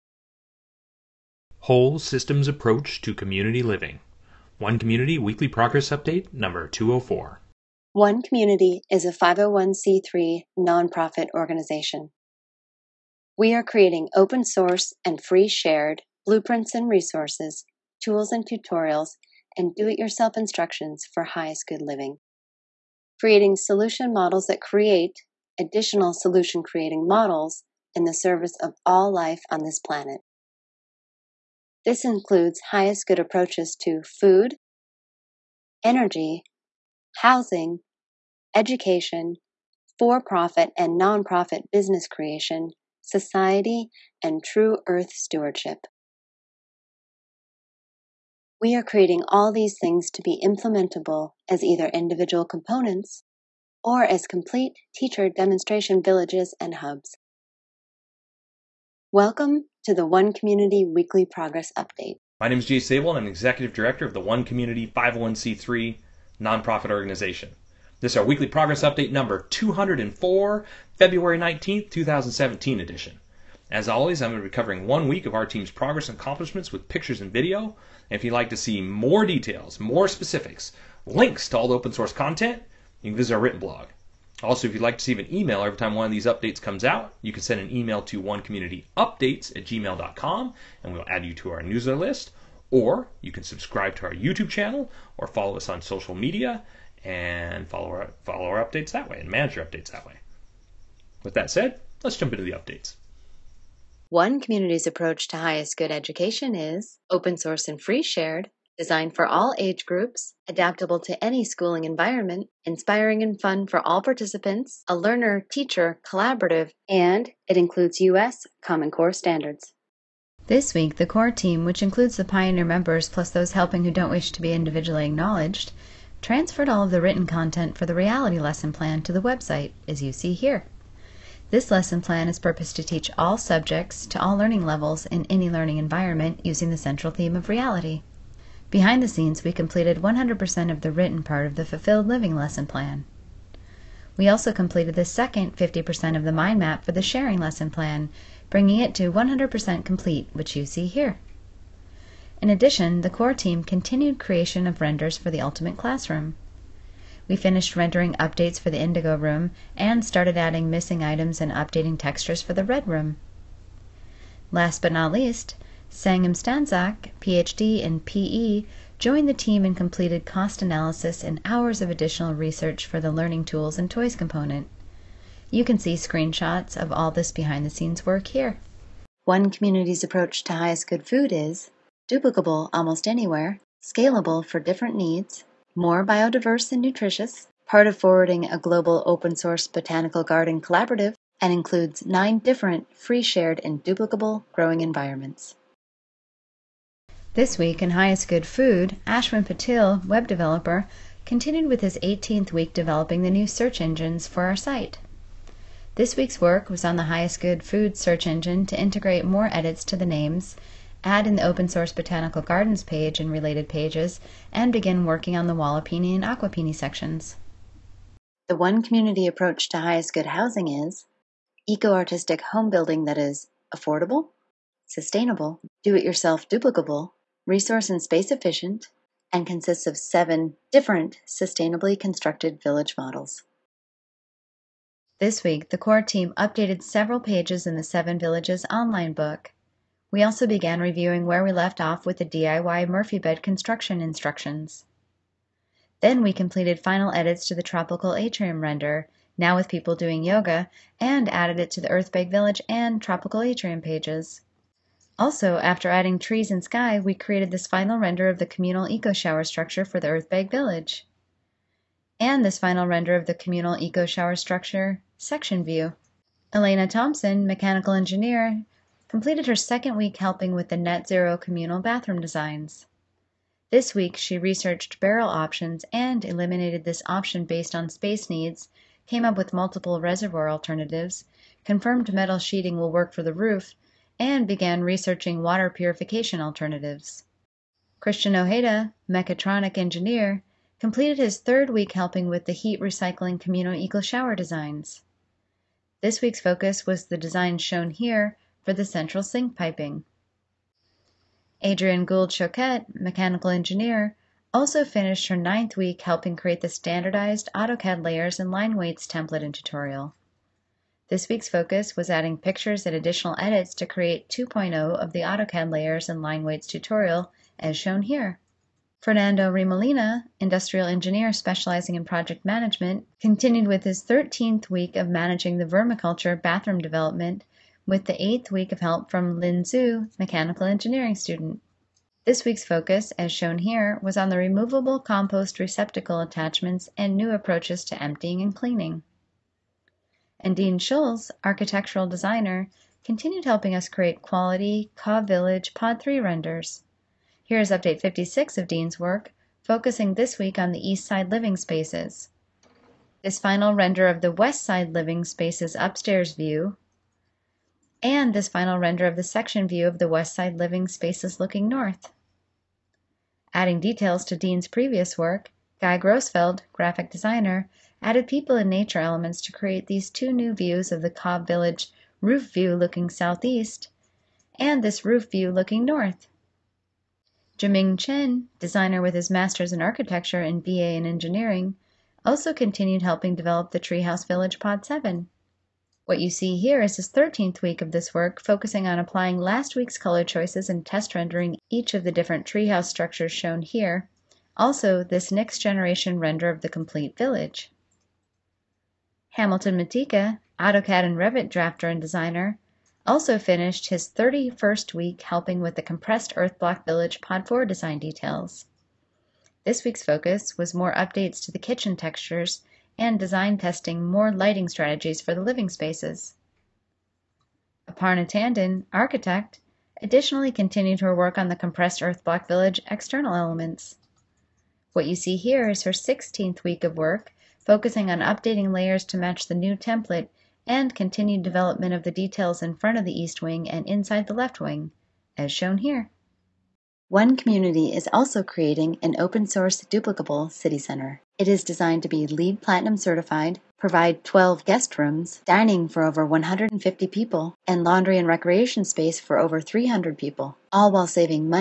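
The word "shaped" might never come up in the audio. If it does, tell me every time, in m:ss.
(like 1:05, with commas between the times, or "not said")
not said.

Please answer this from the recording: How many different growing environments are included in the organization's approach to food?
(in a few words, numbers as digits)
9.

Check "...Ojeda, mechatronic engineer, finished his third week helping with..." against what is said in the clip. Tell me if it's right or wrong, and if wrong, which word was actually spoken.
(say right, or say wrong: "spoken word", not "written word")
wrong: "completed", not "finished".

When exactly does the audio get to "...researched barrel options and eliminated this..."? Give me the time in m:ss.
4:34.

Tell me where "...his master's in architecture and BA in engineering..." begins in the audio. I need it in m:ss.
6:19.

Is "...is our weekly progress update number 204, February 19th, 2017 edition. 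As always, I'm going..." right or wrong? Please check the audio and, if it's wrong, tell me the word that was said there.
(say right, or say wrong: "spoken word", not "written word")
right.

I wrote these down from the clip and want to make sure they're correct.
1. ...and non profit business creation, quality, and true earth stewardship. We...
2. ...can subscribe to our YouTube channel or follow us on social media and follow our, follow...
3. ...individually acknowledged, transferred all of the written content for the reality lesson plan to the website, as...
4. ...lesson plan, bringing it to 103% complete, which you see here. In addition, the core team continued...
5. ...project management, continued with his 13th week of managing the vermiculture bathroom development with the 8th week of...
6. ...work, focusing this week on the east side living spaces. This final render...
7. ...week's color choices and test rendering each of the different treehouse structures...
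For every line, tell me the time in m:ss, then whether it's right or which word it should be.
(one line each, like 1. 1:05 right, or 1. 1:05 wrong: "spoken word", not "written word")
1. 0:40 wrong: "society", not "quality"
2. 1:33 right
3. 2:04 right
4. 2:27 wrong: "100", not "103"
5. 5:22 right
6. 5:48 right
7. 6:29 right.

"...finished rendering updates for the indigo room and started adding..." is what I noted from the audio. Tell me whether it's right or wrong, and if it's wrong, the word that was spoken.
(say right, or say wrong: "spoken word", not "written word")
right.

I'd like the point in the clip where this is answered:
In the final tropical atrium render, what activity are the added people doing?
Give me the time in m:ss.
4:10.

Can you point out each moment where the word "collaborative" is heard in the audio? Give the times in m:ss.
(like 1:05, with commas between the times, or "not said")
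1:56, 3:10.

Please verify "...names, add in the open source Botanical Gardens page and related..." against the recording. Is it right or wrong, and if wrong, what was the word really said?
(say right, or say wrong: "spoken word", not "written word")
right.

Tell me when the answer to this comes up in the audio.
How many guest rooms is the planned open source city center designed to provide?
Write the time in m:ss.
7:24.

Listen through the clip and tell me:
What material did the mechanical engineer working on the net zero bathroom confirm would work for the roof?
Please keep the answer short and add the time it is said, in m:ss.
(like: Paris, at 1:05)
metal sheeting, at 4:42.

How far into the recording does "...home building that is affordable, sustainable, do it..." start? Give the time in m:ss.
3:42.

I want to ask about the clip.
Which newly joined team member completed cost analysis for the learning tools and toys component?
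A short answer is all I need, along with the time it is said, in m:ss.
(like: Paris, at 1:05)
Sangam Stanzak, at 2:45.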